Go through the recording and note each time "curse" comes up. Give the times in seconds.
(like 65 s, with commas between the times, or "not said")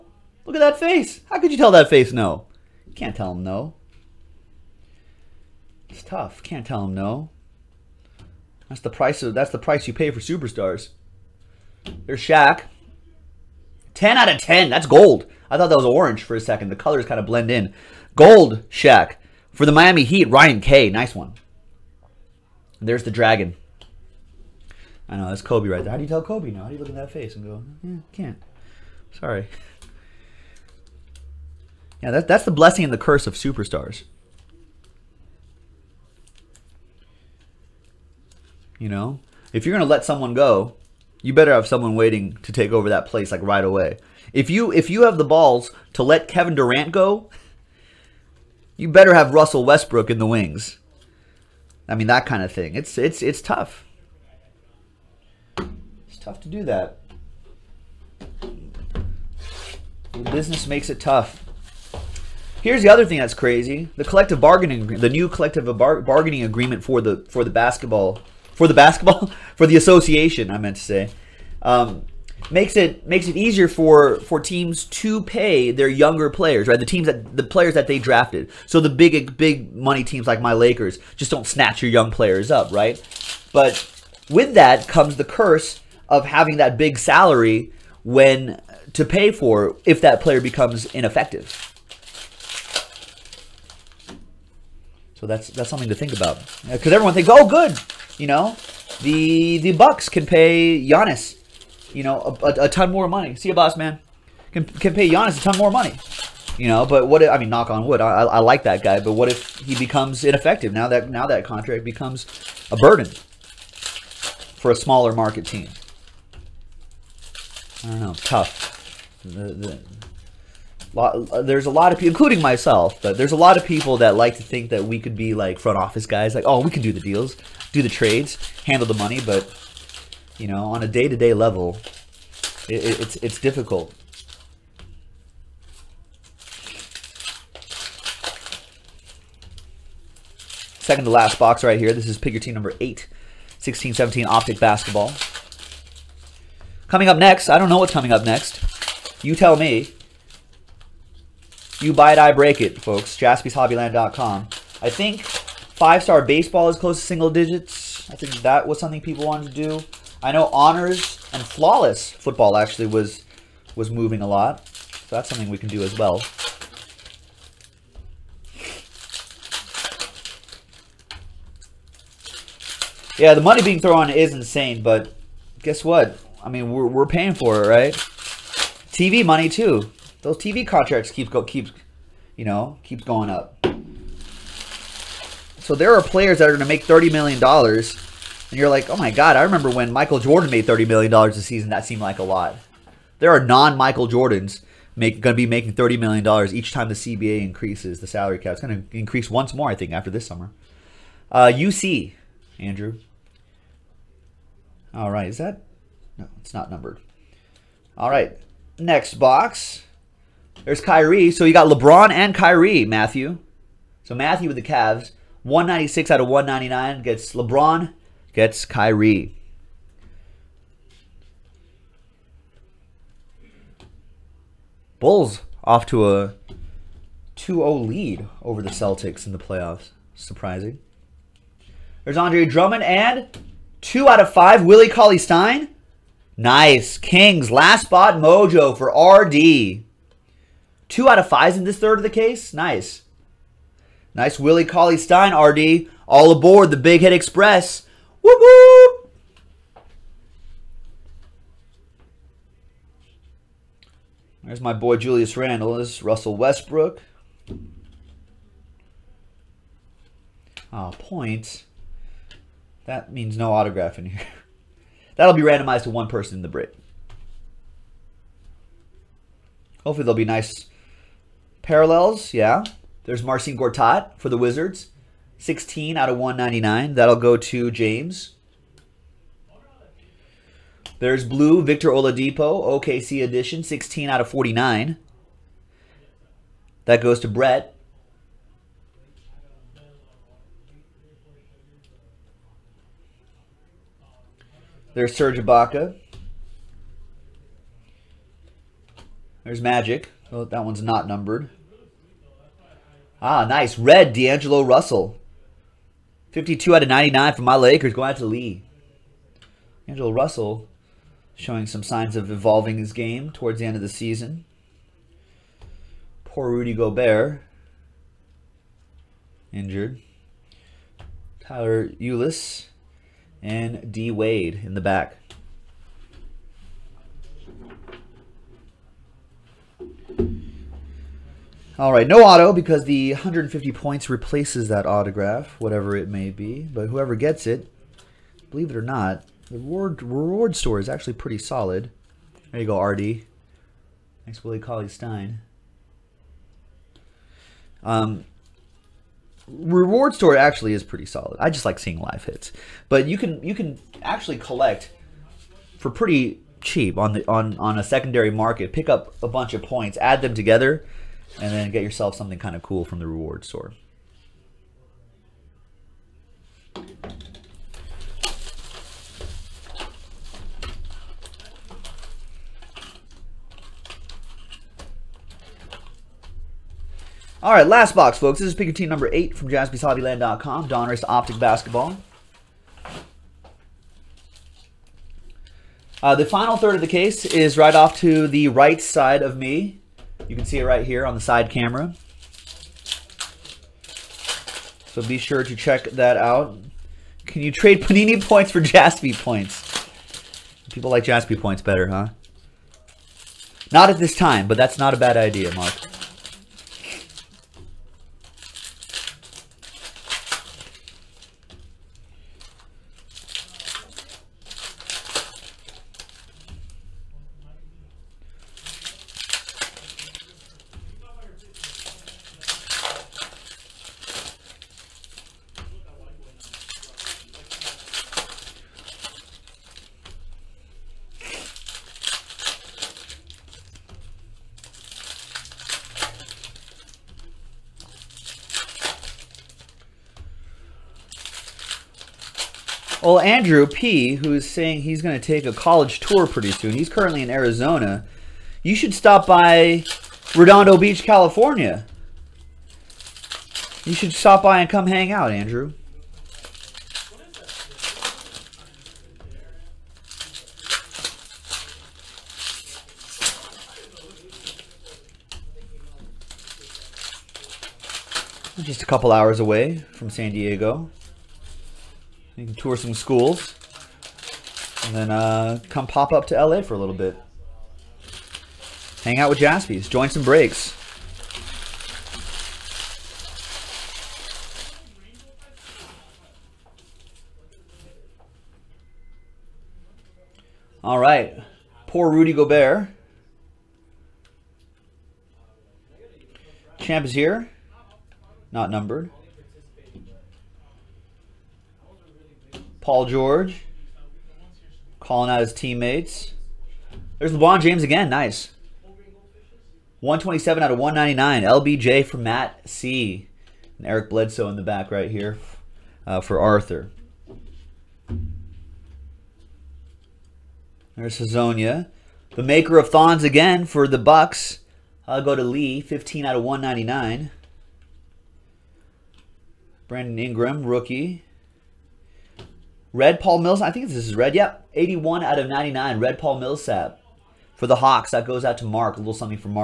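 32 s, 85 s.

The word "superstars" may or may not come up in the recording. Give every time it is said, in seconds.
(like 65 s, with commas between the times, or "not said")
10 s, 33 s.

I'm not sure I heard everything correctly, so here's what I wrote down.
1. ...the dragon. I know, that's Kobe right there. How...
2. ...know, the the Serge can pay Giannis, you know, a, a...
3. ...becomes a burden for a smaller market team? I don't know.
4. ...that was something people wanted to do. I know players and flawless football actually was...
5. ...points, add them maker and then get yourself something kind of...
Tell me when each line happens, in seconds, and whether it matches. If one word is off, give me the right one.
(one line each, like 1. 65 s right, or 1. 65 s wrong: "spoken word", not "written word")
1. 23 s right
2. 98 s wrong: "Bucks", not "Serge"
3. 111 s right
4. 158 s wrong: "honors", not "players"
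5. 359 s wrong: "together", not "maker".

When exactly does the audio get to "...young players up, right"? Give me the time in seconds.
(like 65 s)
81 s.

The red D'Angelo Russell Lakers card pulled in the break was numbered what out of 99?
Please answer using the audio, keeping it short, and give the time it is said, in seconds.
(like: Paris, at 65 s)
52, at 306 s.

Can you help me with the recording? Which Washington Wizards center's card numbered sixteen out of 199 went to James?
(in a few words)
Marcin Gortat.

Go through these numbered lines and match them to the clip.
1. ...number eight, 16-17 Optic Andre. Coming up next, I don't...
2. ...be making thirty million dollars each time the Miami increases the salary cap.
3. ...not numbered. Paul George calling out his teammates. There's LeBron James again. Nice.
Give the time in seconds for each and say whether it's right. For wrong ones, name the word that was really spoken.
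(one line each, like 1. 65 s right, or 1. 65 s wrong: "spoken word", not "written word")
1. 142 s wrong: "Basketball", not "Andre"
2. 195 s wrong: "CBA", not "Miami"
3. 498 s right.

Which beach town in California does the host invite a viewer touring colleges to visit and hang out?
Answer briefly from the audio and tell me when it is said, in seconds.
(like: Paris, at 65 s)
Redondo Beach, at 450 s.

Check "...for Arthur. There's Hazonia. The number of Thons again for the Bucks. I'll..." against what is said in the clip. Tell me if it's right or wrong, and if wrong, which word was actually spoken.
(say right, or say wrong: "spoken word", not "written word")
wrong: "maker", not "number".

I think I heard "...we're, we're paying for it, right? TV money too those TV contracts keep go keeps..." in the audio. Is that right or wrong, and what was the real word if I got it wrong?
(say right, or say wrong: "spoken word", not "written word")
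right.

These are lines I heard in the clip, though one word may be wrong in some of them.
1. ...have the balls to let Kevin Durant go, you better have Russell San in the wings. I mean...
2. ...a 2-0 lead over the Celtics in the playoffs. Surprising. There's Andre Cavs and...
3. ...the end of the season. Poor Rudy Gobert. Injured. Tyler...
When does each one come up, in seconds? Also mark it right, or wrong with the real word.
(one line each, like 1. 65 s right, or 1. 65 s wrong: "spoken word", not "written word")
1. 45 s wrong: "Westbrook", not "San"
2. 226 s wrong: "Drummond", not "Cavs"
3. 313 s right.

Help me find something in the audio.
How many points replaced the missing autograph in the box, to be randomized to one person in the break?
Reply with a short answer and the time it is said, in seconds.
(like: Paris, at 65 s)
150, at 333 s.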